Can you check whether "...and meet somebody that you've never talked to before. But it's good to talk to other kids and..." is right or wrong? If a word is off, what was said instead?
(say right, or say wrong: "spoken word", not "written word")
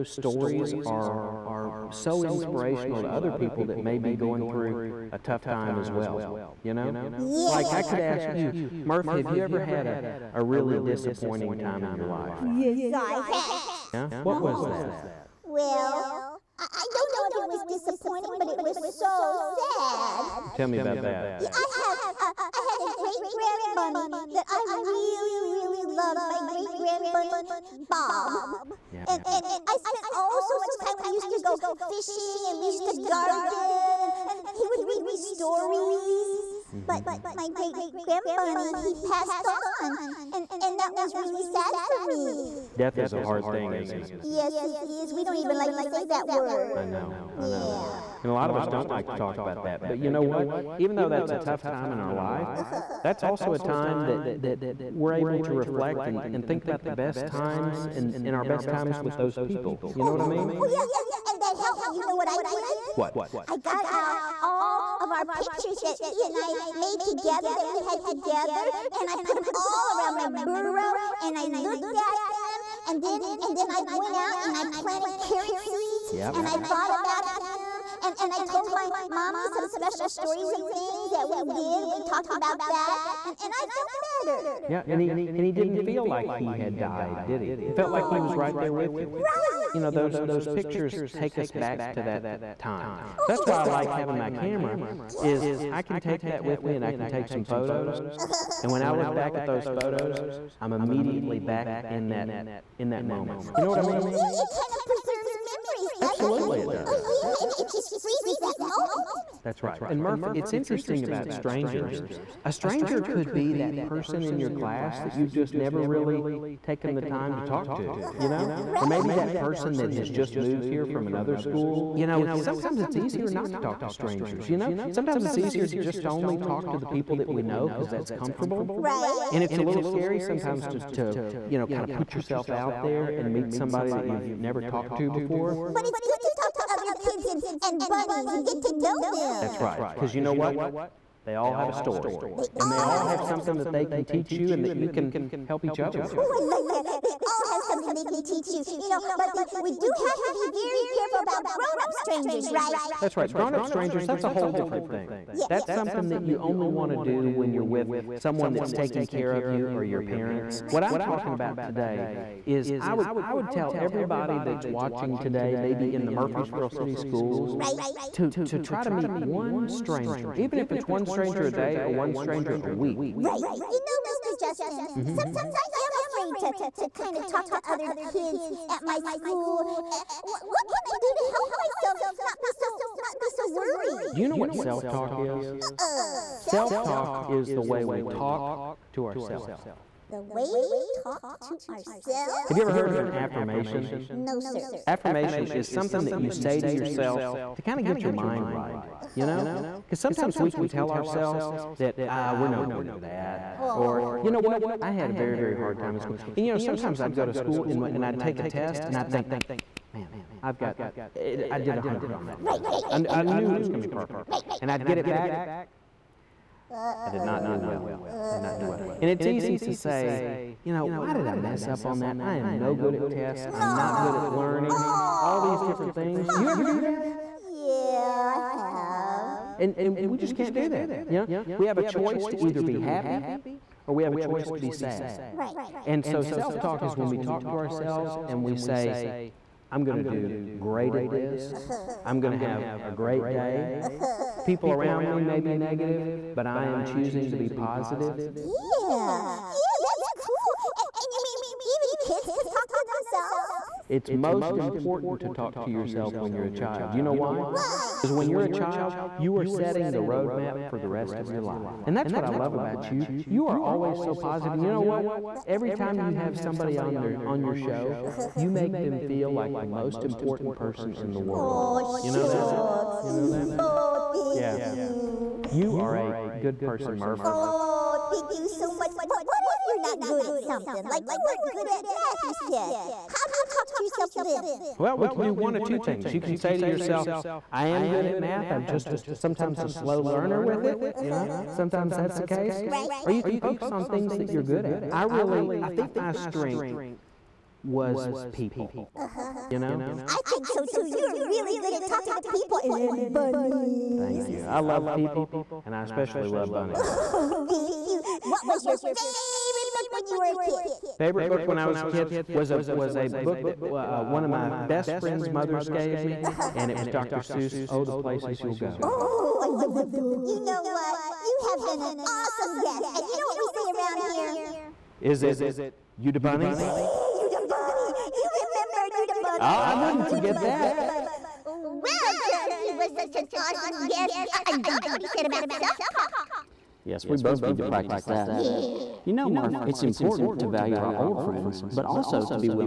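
right.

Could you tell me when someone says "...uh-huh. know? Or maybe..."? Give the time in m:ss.
1:58.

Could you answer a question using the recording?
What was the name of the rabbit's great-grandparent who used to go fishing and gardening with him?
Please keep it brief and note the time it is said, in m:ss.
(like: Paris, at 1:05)
Bob, at 0:27.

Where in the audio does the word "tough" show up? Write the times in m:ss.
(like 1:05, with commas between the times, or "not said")
0:05, 0:51.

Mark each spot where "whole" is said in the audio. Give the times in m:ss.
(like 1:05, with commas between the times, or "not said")
2:34.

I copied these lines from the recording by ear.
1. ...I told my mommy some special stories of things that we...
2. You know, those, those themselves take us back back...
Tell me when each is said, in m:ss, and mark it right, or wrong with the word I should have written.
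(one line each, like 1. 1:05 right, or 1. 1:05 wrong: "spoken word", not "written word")
1. 1:18 right
2. 1:29 wrong: "pictures", not "themselves".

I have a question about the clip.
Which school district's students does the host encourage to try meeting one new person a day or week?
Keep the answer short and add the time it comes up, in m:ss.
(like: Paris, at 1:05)
Murfreesboro City Schools, at 2:46.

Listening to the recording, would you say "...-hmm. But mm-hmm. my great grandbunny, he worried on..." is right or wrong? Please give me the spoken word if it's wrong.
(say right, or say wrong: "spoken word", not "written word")
wrong: "passed", not "worried".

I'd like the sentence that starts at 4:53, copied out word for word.
Or you can focus on things that you're good at.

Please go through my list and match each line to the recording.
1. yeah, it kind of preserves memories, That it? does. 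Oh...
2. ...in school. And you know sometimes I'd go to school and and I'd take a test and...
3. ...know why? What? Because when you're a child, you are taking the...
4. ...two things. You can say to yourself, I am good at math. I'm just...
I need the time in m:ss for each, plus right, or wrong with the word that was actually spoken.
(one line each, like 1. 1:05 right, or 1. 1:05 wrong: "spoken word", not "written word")
1. 1:44 wrong: "Absolutely", not "That"
2. 3:25 right
3. 4:17 wrong: "setting", not "taking"
4. 4:45 right.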